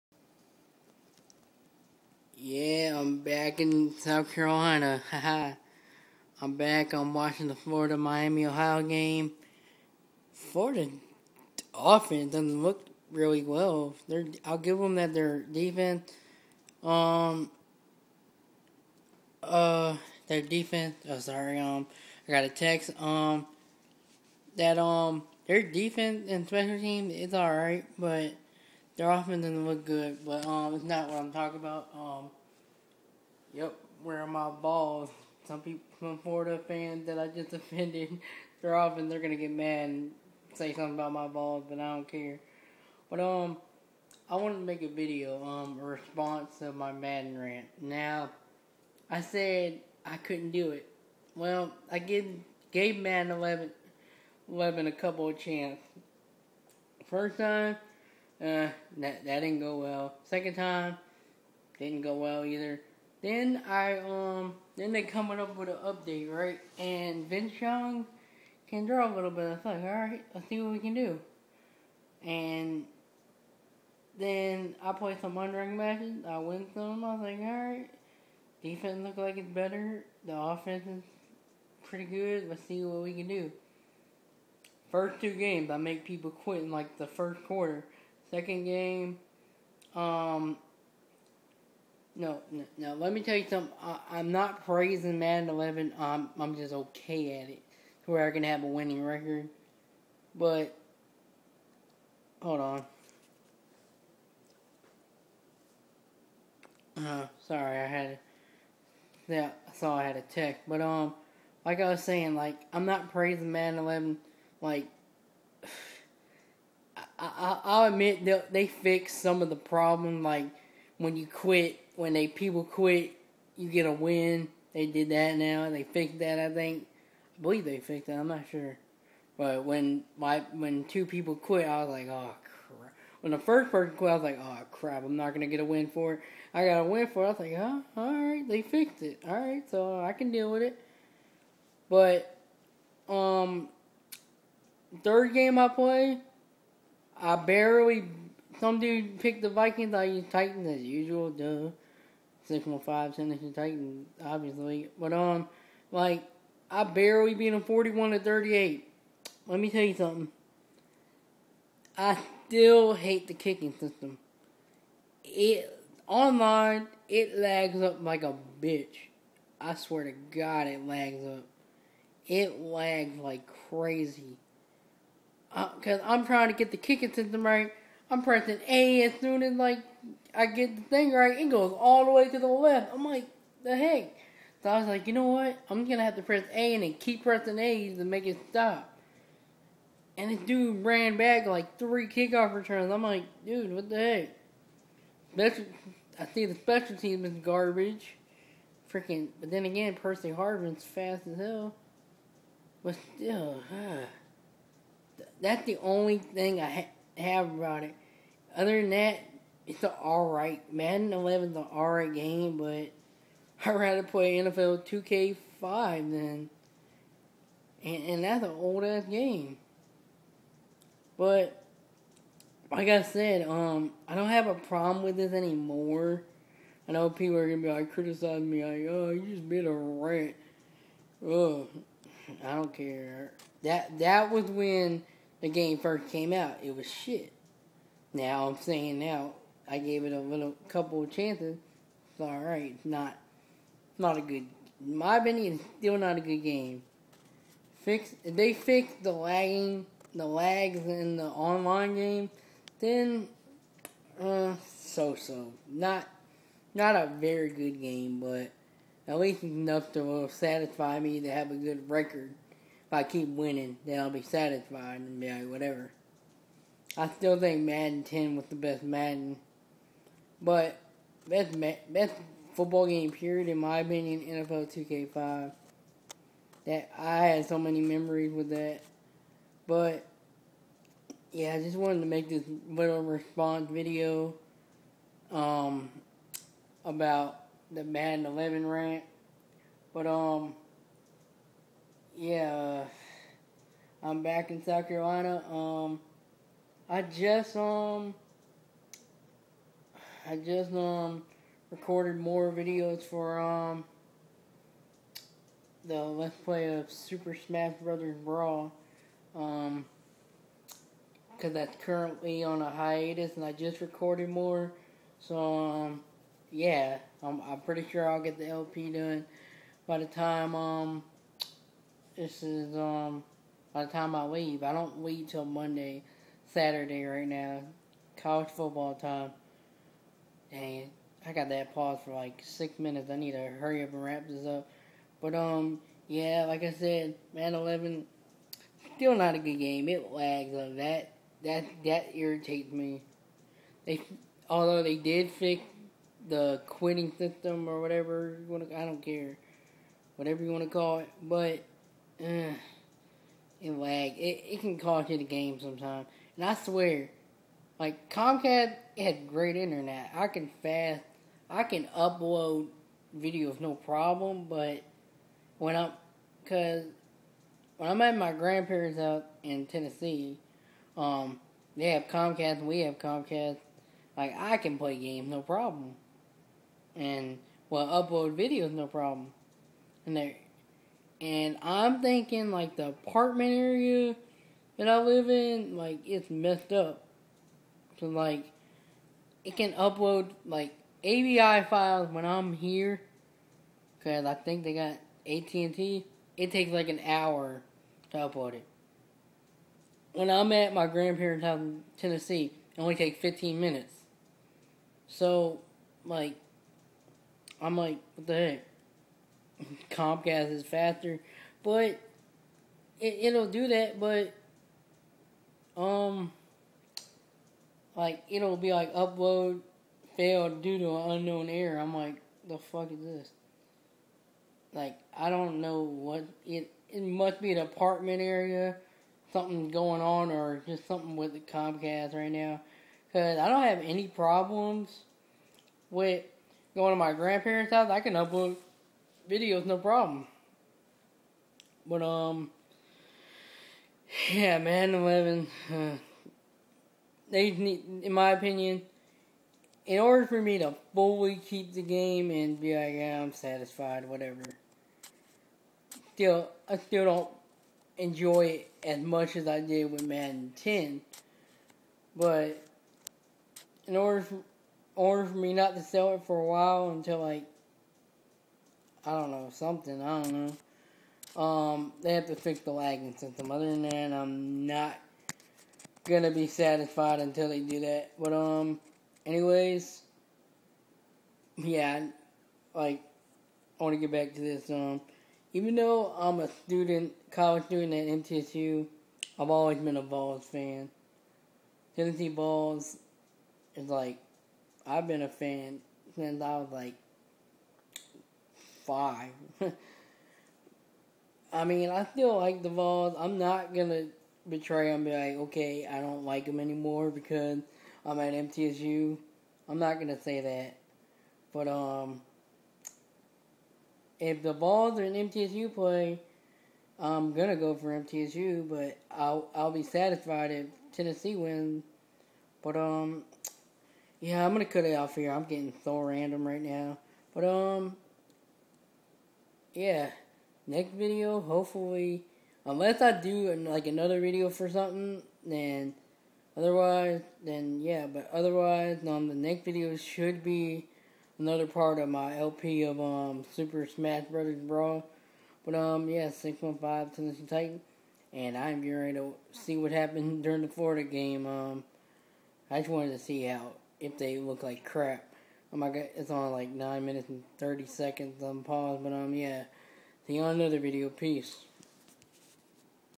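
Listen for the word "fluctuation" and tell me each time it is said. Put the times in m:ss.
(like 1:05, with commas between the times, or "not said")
not said.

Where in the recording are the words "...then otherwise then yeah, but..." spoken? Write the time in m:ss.
8:55.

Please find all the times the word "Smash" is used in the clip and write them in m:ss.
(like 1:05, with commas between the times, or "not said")
5:07, 9:03.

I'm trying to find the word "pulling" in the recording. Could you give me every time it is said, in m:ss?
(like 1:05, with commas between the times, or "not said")
not said.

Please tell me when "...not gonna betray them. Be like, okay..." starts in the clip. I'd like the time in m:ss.
8:23.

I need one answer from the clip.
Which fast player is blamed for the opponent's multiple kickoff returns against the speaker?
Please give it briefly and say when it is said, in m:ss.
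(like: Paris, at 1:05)
Percy Harvin, at 3:19.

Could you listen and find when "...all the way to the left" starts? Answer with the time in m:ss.
3:01.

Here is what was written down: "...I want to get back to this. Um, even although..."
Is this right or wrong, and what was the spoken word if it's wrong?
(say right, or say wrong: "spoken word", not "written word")
wrong: "though", not "although".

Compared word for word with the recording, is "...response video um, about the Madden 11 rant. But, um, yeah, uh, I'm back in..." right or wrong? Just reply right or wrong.
right.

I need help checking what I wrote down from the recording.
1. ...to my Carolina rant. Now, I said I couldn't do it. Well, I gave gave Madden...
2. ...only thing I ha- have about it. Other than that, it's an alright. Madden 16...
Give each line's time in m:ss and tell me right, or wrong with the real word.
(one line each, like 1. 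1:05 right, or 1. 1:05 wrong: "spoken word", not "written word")
1. 0:46 wrong: "Madden", not "Carolina"
2. 3:25 wrong: "11", not "16".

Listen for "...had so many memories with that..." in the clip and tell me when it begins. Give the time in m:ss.
4:37.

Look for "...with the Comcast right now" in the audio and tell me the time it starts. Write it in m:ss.
7:11.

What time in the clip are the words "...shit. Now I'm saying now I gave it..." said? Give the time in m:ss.
3:56.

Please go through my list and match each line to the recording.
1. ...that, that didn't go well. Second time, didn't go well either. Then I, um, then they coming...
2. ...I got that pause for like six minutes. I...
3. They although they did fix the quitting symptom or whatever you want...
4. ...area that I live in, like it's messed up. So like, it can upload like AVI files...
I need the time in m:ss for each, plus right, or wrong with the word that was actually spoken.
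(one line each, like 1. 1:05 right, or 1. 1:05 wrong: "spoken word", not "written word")
1. 0:58 right
2. 5:31 right
3. 5:43 right
4. 6:23 right.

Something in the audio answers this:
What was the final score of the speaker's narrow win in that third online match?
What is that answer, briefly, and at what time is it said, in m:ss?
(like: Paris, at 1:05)
41 to 38, at 2:37.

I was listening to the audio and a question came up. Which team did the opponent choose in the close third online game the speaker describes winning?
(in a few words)
Vikings.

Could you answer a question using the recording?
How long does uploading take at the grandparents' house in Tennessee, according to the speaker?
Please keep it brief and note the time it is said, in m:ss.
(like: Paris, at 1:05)
15 minutes, at 6:43.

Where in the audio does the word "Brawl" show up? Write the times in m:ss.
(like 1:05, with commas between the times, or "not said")
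5:08, 9:04.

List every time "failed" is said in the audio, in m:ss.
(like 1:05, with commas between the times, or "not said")
7:00.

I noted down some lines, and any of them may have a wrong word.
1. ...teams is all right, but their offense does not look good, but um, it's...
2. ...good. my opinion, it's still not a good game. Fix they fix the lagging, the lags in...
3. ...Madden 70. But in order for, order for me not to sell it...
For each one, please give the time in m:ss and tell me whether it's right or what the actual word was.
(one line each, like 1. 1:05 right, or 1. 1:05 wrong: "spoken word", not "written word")
1. 0:26 right
2. 4:04 right
3. 7:40 wrong: "10", not "70".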